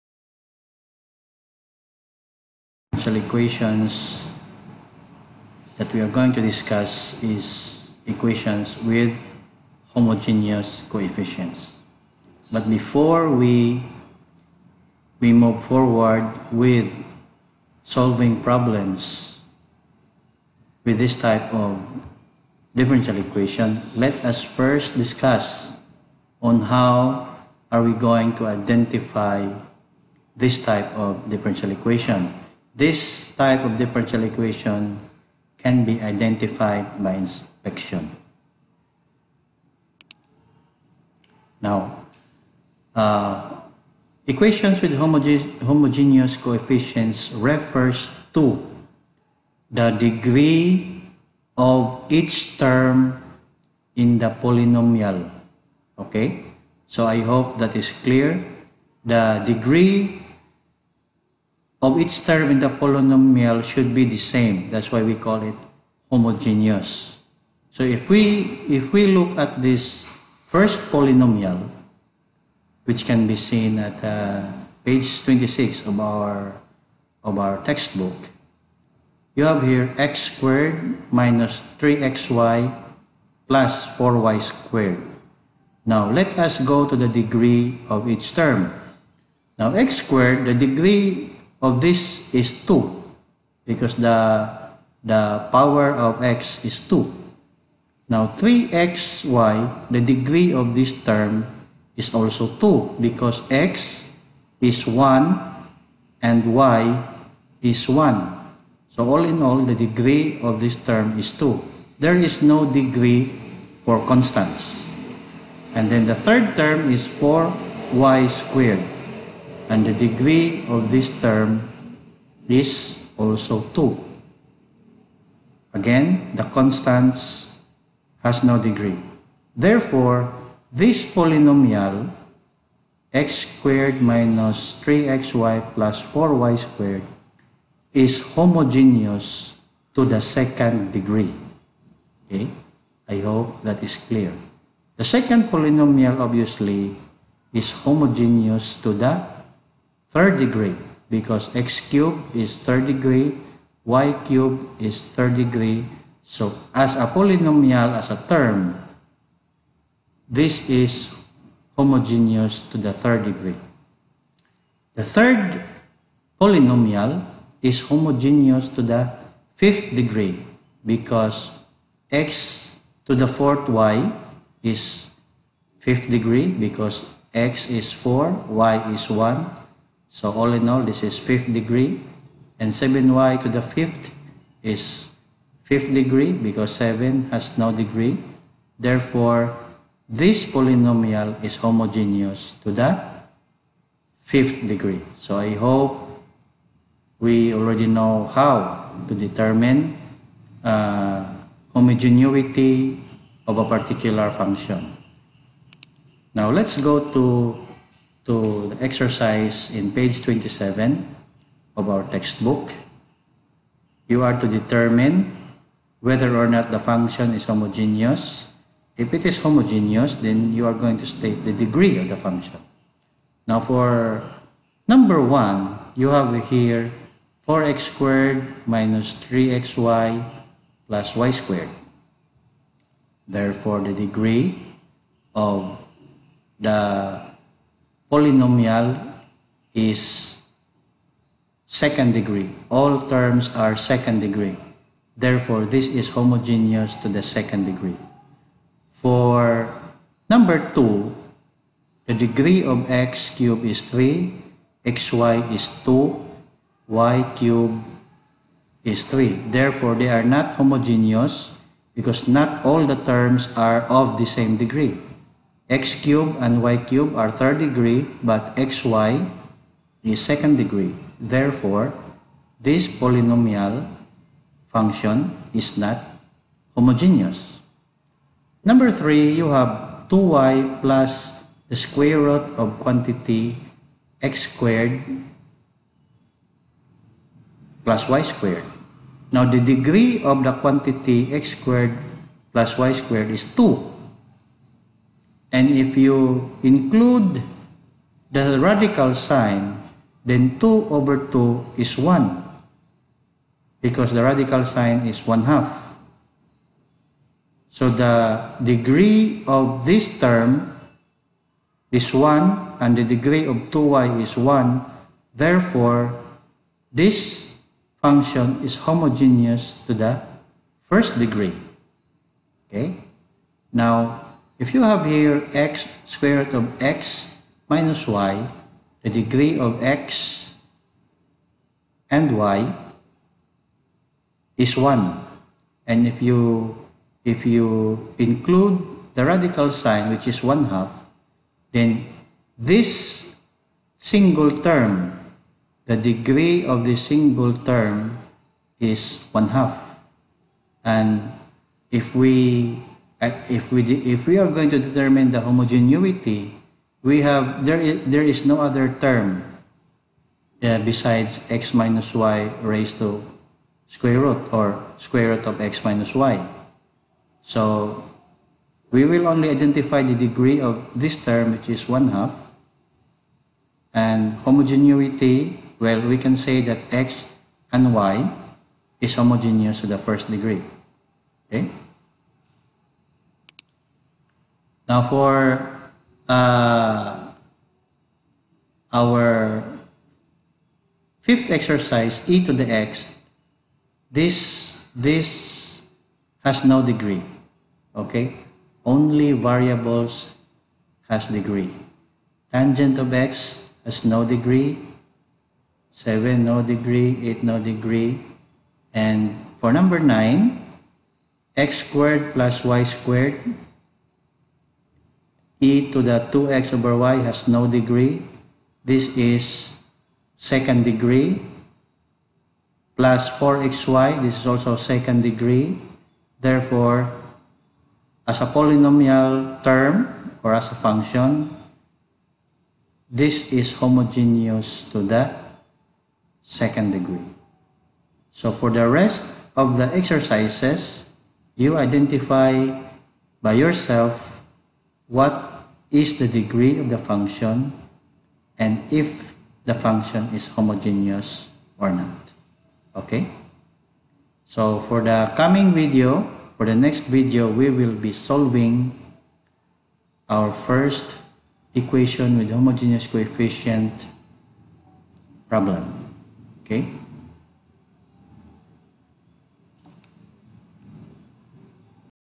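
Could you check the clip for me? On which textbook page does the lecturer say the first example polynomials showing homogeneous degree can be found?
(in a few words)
26.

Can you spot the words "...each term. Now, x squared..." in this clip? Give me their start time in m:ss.
1:28.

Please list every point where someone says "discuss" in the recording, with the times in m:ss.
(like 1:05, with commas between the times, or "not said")
0:06, 0:24.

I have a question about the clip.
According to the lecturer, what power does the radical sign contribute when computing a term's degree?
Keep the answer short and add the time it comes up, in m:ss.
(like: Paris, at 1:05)
1/2, at 5:04.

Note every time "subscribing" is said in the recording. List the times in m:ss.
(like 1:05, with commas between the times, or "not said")
not said.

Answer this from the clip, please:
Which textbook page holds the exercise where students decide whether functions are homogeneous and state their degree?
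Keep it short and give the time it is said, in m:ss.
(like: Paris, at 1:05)
27, at 3:29.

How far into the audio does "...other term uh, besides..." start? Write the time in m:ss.
5:58.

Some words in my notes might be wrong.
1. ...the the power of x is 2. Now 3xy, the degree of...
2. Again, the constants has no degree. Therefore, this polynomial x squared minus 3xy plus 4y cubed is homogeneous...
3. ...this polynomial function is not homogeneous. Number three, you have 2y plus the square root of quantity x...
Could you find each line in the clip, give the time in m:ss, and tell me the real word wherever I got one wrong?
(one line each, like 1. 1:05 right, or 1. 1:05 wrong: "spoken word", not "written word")
1. 1:34 right
2. 2:05 wrong: "squared", not "cubed"
3. 4:32 right.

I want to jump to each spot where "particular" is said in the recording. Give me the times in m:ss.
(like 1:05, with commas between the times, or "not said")
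3:23.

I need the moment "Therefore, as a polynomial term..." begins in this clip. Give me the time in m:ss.
7:06.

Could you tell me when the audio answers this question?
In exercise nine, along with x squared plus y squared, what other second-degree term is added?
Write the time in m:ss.
7:03.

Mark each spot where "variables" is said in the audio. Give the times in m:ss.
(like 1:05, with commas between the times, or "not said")
6:39.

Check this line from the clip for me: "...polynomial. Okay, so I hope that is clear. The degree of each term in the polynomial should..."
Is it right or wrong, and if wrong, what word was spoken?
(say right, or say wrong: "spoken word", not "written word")
right.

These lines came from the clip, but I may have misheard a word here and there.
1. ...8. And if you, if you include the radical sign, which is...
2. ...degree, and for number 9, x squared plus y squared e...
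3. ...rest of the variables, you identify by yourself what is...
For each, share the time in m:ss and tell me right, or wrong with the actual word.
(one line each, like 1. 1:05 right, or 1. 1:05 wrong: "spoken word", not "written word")
1. 5:34 wrong: "1", not "8"
2. 6:47 right
3. 7:18 wrong: "exercises", not "variables".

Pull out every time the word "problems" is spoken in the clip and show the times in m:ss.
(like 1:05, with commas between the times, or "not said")
0:18, 7:45.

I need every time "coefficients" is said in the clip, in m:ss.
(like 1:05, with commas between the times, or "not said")
0:10, 0:46, 7:43.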